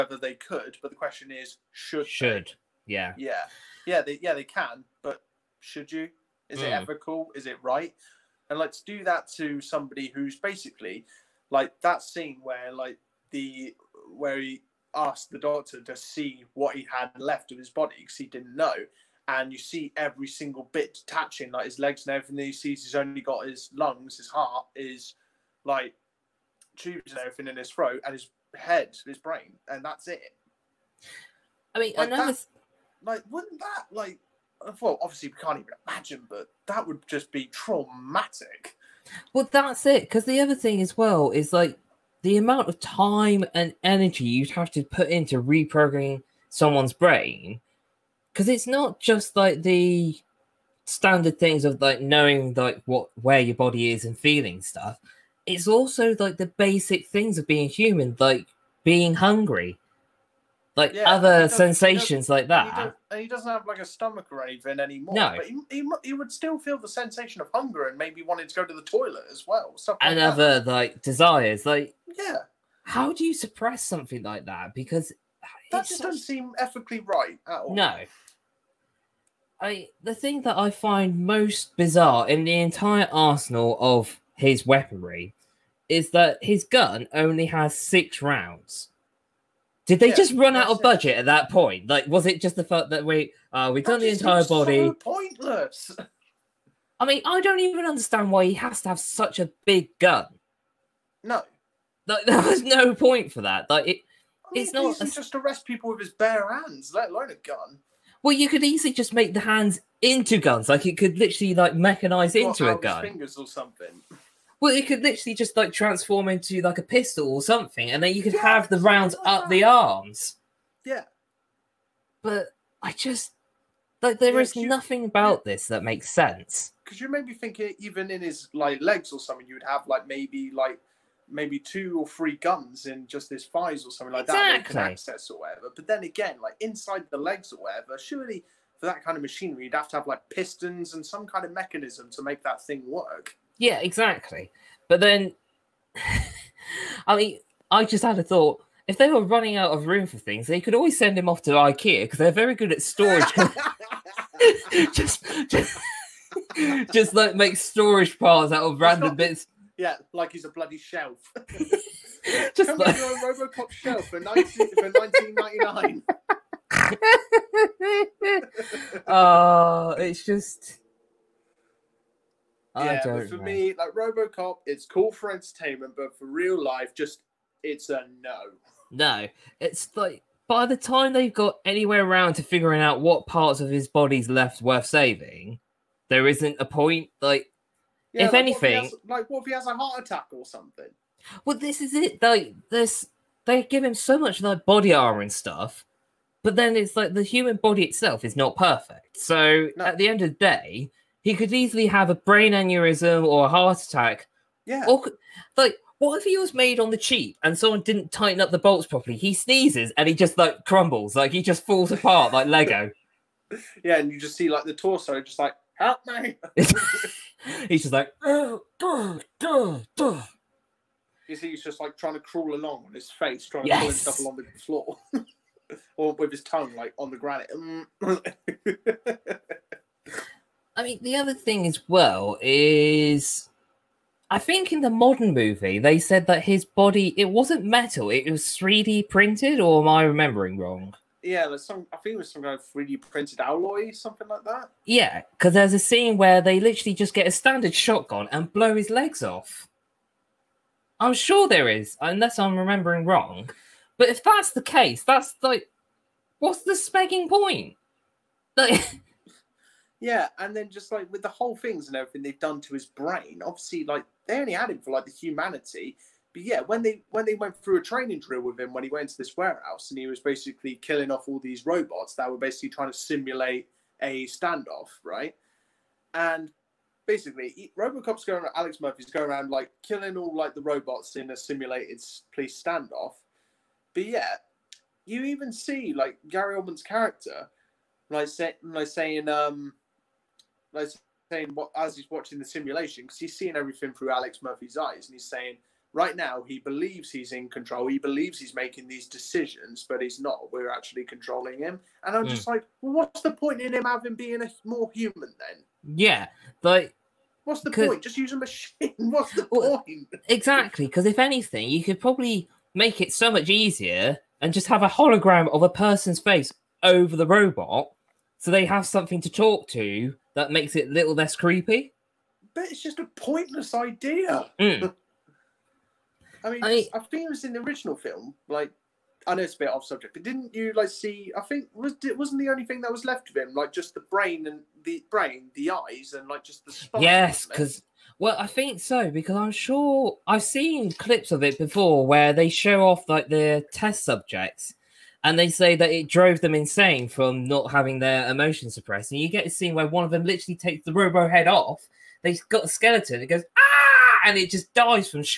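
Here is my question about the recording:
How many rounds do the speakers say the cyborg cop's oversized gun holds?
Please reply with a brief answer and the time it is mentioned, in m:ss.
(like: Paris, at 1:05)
6, at 1:27.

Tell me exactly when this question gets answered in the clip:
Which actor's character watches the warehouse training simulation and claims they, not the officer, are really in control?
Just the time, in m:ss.
4:46.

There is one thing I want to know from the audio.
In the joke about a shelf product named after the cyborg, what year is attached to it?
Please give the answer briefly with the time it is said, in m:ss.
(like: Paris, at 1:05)
1999, at 2:44.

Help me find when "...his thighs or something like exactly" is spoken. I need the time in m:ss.
2:13.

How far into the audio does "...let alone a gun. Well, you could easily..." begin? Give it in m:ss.
1:46.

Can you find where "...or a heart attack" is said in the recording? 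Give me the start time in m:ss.
3:23.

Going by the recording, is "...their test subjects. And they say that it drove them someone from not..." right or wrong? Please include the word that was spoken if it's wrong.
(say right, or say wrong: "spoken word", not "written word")
wrong: "insane", not "someone".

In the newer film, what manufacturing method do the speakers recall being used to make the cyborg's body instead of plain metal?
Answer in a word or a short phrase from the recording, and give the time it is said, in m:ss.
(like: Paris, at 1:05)
3D printed, at 3:58.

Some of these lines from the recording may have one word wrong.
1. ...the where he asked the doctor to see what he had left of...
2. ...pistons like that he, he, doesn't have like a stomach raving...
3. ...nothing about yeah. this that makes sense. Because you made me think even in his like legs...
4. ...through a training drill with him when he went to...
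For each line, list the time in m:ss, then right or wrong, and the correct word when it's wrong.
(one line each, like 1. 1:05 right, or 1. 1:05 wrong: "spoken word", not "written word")
1. 0:13 right
2. 1:01 wrong: "sensations", not "pistons"
3. 2:04 right
4. 4:27 right.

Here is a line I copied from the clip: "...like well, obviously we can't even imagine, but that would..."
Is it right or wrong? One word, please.
right.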